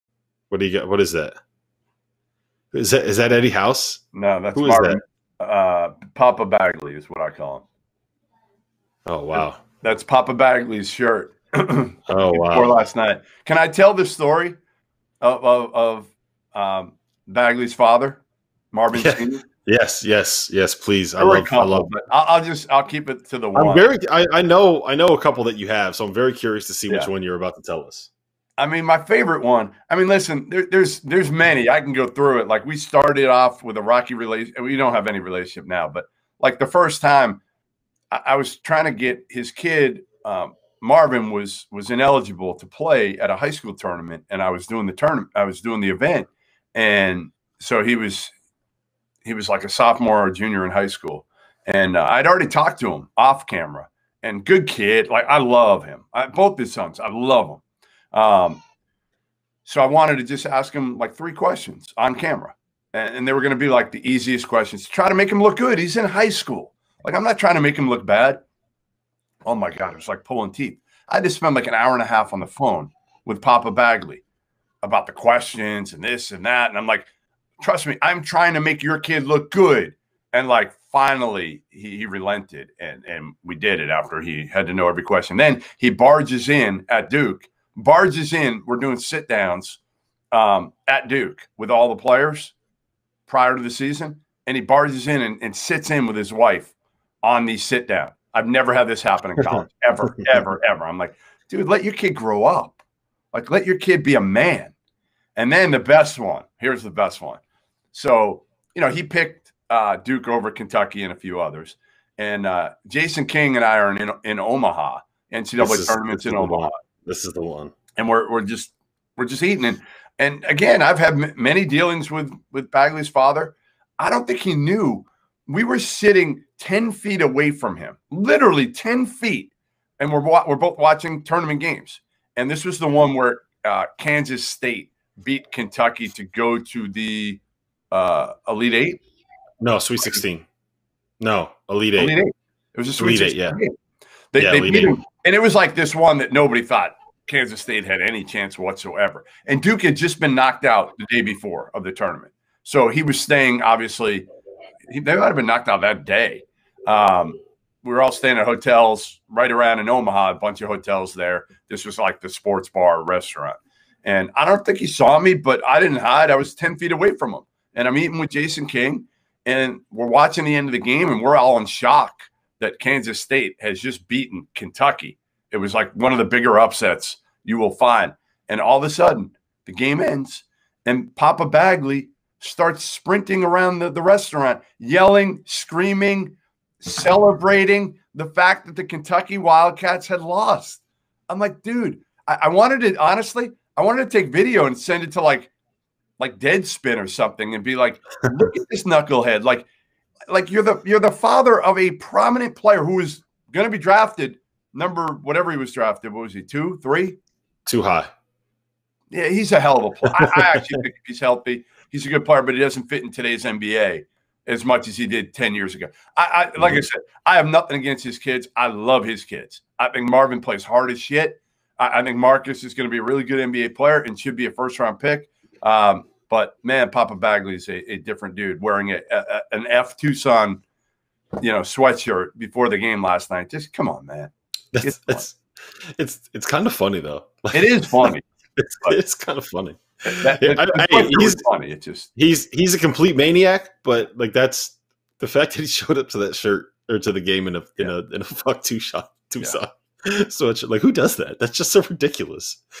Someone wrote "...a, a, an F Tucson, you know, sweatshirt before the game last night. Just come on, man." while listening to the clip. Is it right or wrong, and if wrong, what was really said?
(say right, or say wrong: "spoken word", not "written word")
right.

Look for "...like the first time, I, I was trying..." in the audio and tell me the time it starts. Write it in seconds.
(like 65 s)
36 s.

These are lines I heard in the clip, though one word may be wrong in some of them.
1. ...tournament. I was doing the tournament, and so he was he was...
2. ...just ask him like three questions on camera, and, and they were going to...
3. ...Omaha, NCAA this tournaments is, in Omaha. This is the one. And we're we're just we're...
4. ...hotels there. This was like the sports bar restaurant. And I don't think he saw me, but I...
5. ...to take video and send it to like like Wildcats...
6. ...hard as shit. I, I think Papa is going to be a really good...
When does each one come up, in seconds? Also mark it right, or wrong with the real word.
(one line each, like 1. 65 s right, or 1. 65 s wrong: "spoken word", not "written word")
1. 44 s wrong: "event", not "tournament"
2. 60 s right
3. 114 s right
4. 160 s right
5. 194 s wrong: "Deadspin", not "Wildcats"
6. 220 s wrong: "Marcus", not "Papa".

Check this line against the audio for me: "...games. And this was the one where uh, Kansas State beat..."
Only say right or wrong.
right.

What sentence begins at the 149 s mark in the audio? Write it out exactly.
And Duke had just been knocked out the day before of the tournament.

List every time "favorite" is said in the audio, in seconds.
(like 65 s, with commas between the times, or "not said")
29 s.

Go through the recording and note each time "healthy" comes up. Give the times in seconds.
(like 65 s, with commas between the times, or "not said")
211 s.